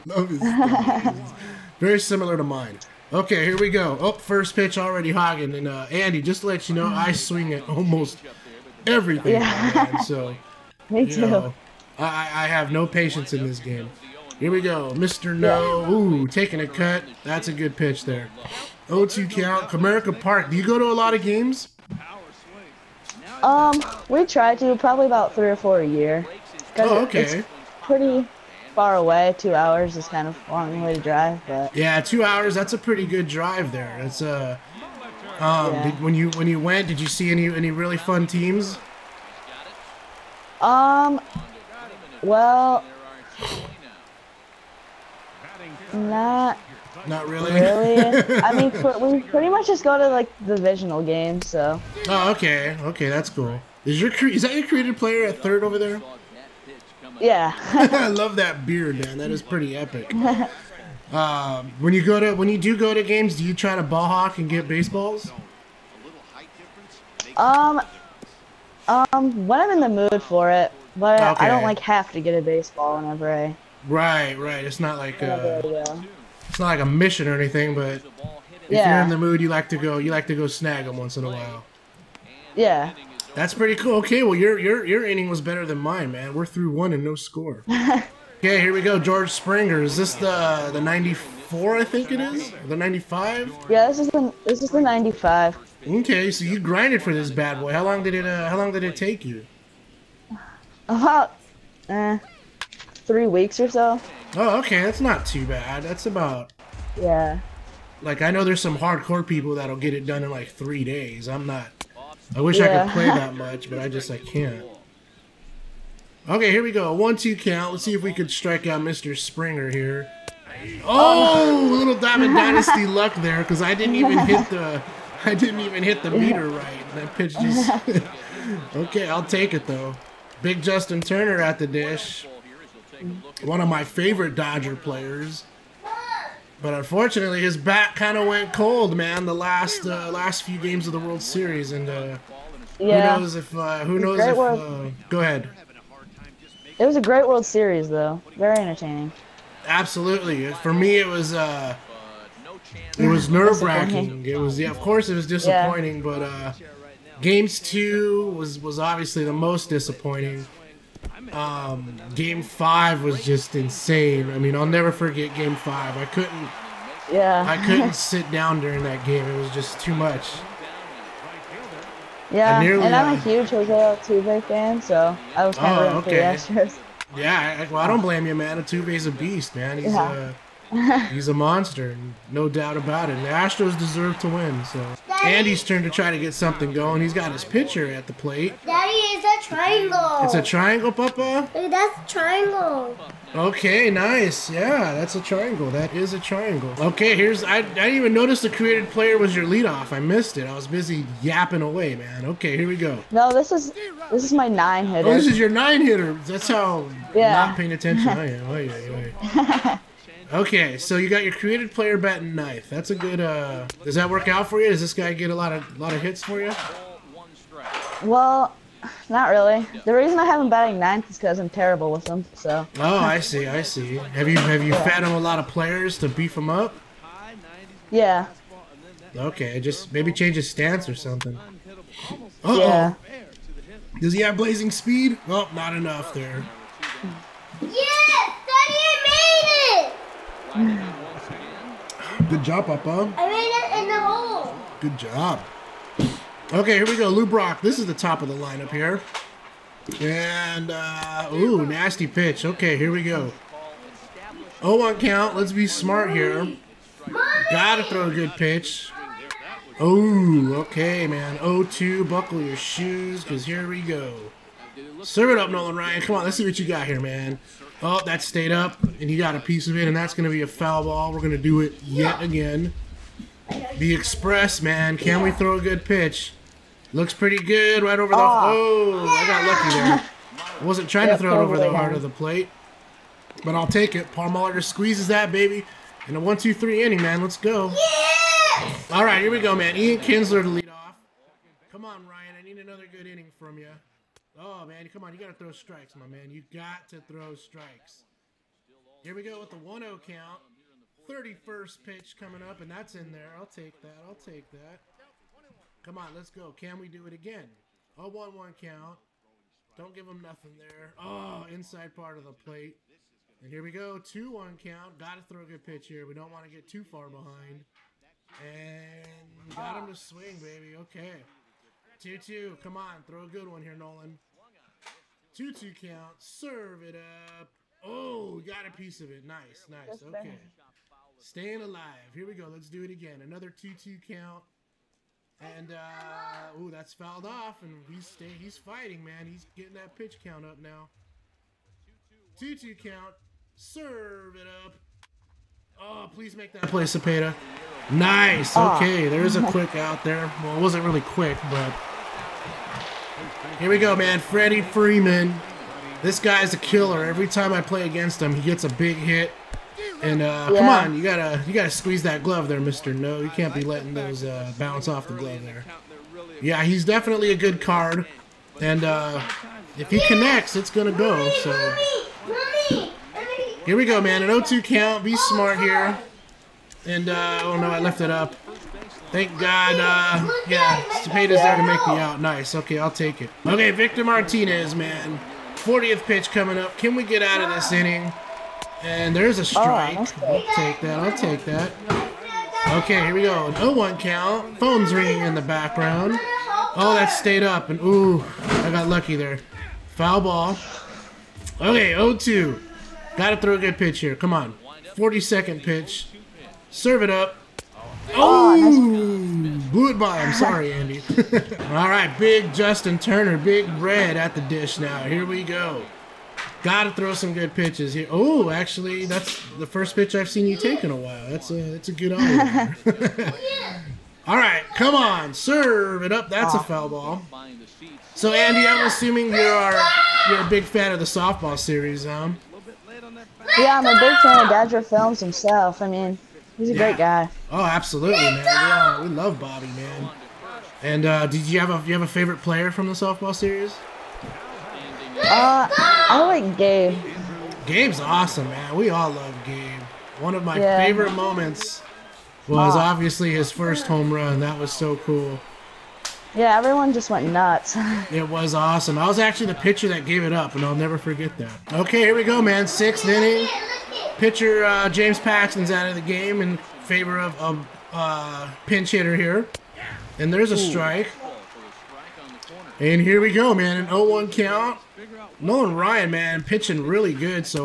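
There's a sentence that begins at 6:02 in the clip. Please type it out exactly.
No, you can't be letting those uh, bounce off the glove there.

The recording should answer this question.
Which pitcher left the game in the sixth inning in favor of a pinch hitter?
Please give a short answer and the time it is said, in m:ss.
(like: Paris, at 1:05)
James Paxton, at 7:44.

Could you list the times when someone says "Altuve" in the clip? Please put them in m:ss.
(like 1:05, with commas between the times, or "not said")
2:53, 2:58.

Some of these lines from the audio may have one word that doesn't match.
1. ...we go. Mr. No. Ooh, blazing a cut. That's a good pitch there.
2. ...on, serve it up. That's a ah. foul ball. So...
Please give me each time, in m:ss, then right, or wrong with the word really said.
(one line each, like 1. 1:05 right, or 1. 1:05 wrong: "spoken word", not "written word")
1. 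0:14 wrong: "taking", not "blazing"
2. 7:04 right.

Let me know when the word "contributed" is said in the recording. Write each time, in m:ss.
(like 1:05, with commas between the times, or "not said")
not said.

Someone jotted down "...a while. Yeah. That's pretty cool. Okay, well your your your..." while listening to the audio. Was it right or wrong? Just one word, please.
right.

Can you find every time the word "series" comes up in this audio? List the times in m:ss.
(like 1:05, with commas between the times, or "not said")
2:21, 2:27, 7:11, 7:23.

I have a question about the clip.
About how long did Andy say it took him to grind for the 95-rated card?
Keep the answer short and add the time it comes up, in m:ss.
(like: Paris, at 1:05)
3 weeks, at 1:43.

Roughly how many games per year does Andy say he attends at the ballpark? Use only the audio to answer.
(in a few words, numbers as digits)
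3 or 4.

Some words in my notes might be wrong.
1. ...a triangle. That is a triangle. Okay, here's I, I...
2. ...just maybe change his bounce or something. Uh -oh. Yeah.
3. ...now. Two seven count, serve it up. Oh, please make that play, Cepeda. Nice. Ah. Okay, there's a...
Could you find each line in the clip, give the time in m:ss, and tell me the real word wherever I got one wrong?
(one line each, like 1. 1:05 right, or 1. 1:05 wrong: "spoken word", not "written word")
1. 3:15 right
2. 3:49 wrong: "stance", not "bounce"
3. 5:40 wrong: "two", not "seven".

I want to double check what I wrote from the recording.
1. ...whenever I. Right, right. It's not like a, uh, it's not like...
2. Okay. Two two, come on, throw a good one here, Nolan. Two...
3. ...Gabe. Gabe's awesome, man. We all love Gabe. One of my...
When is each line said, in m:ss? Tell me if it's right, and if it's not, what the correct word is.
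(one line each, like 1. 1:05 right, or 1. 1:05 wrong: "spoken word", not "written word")
1. 1:13 right
2. 5:20 right
3. 7:26 right.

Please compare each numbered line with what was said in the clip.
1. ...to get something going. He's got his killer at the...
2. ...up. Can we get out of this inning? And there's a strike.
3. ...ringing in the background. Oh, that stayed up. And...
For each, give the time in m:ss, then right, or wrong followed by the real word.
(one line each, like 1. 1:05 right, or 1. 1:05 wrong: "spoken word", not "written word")
1. 3:06 wrong: "pitcher", not "killer"
2. 6:26 right
3. 6:34 right.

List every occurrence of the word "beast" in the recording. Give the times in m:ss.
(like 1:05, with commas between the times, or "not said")
2:59.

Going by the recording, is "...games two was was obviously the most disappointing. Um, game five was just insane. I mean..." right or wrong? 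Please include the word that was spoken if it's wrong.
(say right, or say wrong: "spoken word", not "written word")
right.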